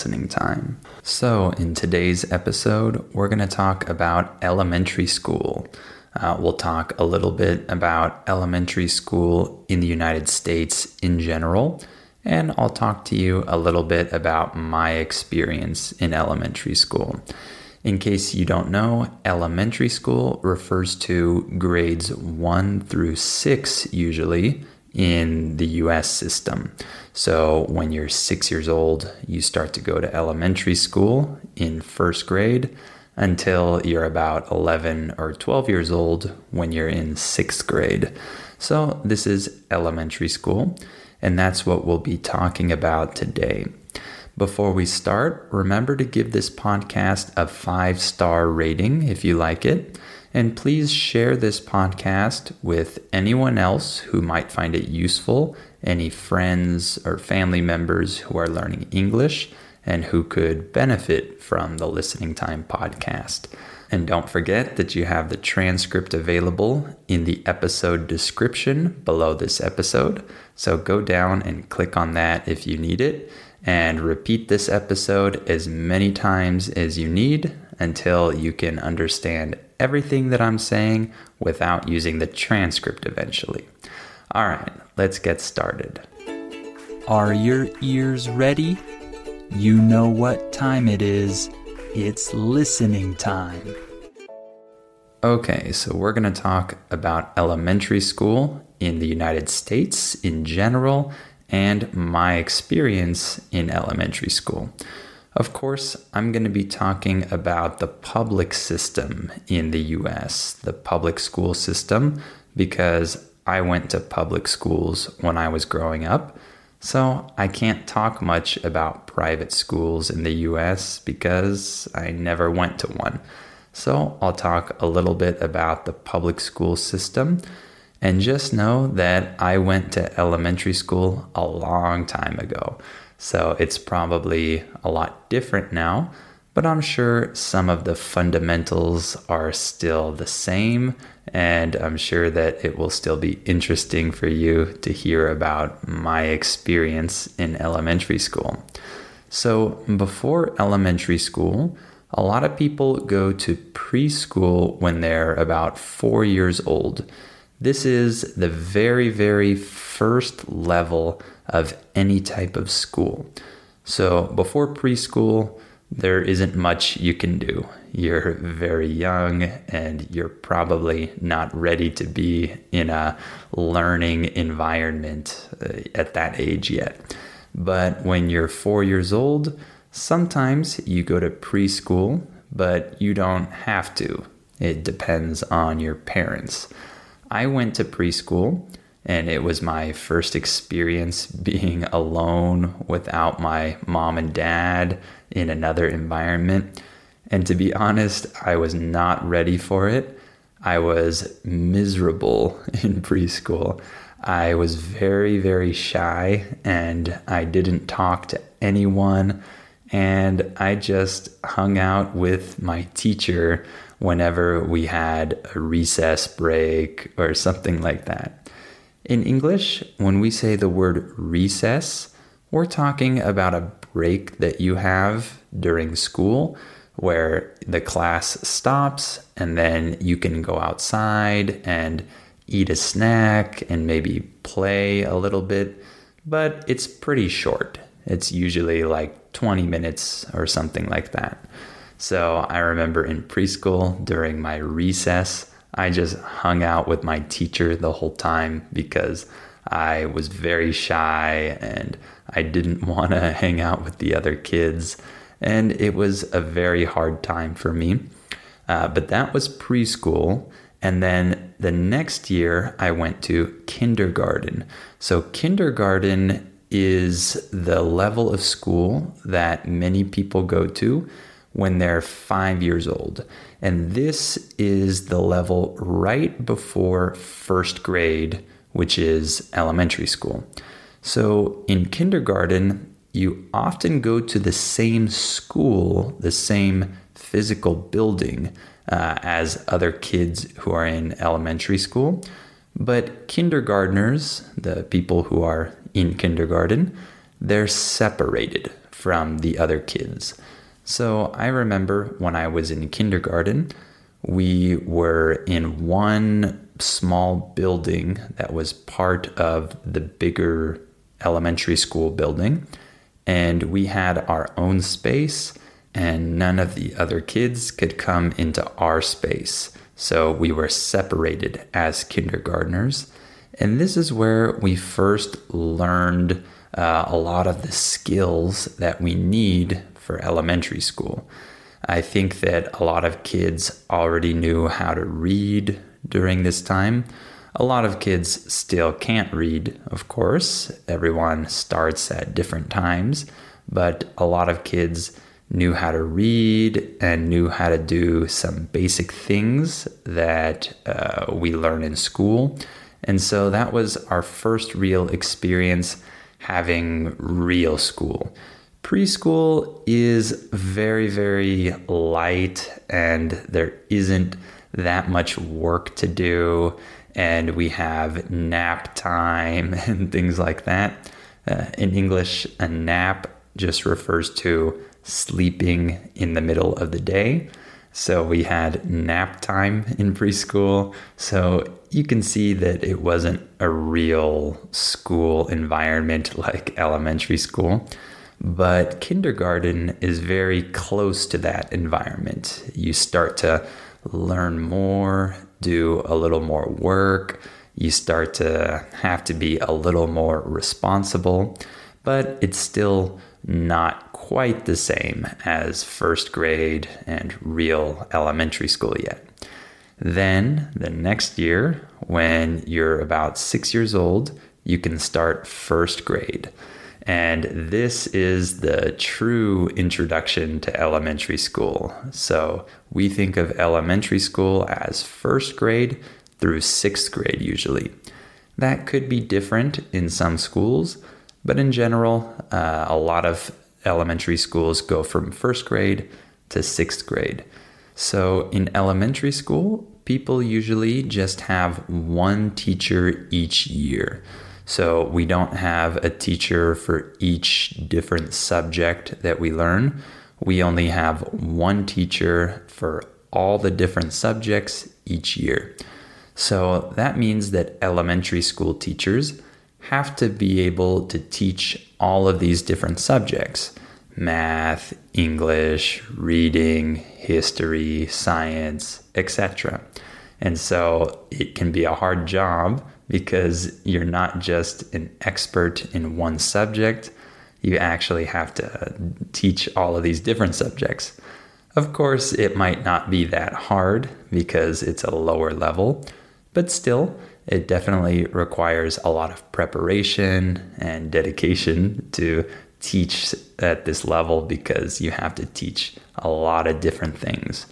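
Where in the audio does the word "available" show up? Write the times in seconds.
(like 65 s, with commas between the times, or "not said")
66 s.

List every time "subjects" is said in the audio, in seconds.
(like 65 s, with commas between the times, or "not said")
448 s, 454 s, 462 s, 476 s, 480 s.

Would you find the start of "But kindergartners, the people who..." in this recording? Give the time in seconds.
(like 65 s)
292 s.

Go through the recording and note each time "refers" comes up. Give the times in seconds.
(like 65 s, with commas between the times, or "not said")
20 s, 373 s.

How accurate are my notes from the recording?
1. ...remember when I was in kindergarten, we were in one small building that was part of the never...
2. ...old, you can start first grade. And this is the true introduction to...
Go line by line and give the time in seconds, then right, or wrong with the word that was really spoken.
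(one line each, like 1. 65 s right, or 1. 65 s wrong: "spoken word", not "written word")
1. 301 s wrong: "bigger", not "never"
2. 413 s right.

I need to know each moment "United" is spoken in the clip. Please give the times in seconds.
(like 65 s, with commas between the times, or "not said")
9 s, 99 s.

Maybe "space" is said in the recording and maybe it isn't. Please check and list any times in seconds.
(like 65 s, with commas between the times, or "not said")
314 s, 319 s.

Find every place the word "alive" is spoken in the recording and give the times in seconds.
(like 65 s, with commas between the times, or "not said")
not said.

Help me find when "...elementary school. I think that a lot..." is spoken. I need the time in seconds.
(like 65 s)
330 s.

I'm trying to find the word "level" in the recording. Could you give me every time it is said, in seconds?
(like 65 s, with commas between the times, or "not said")
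160 s, 267 s, 275 s, 485 s, 494 s.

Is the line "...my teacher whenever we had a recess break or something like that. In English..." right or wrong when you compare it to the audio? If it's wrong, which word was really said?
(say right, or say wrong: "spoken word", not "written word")
right.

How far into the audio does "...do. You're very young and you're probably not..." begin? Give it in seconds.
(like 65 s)
167 s.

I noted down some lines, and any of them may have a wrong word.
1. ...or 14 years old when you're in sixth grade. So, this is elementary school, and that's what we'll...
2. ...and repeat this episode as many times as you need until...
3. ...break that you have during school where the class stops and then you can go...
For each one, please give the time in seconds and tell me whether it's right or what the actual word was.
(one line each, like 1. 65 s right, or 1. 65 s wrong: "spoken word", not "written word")
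1. 35 s wrong: "12", not "14"
2. 73 s right
3. 223 s right.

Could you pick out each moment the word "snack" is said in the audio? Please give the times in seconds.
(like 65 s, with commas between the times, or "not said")
232 s.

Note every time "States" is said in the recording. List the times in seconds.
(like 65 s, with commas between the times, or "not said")
10 s, 99 s.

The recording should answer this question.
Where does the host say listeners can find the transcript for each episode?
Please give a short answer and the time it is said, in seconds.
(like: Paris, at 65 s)
episode description, at 67 s.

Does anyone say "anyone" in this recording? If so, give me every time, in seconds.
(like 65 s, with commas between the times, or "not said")
53 s, 208 s.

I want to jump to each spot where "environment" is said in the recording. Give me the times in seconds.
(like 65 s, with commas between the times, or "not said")
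174 s, 195 s, 385 s, 391 s.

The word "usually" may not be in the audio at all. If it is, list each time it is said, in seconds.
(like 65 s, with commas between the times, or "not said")
23 s, 238 s, 427 s, 440 s.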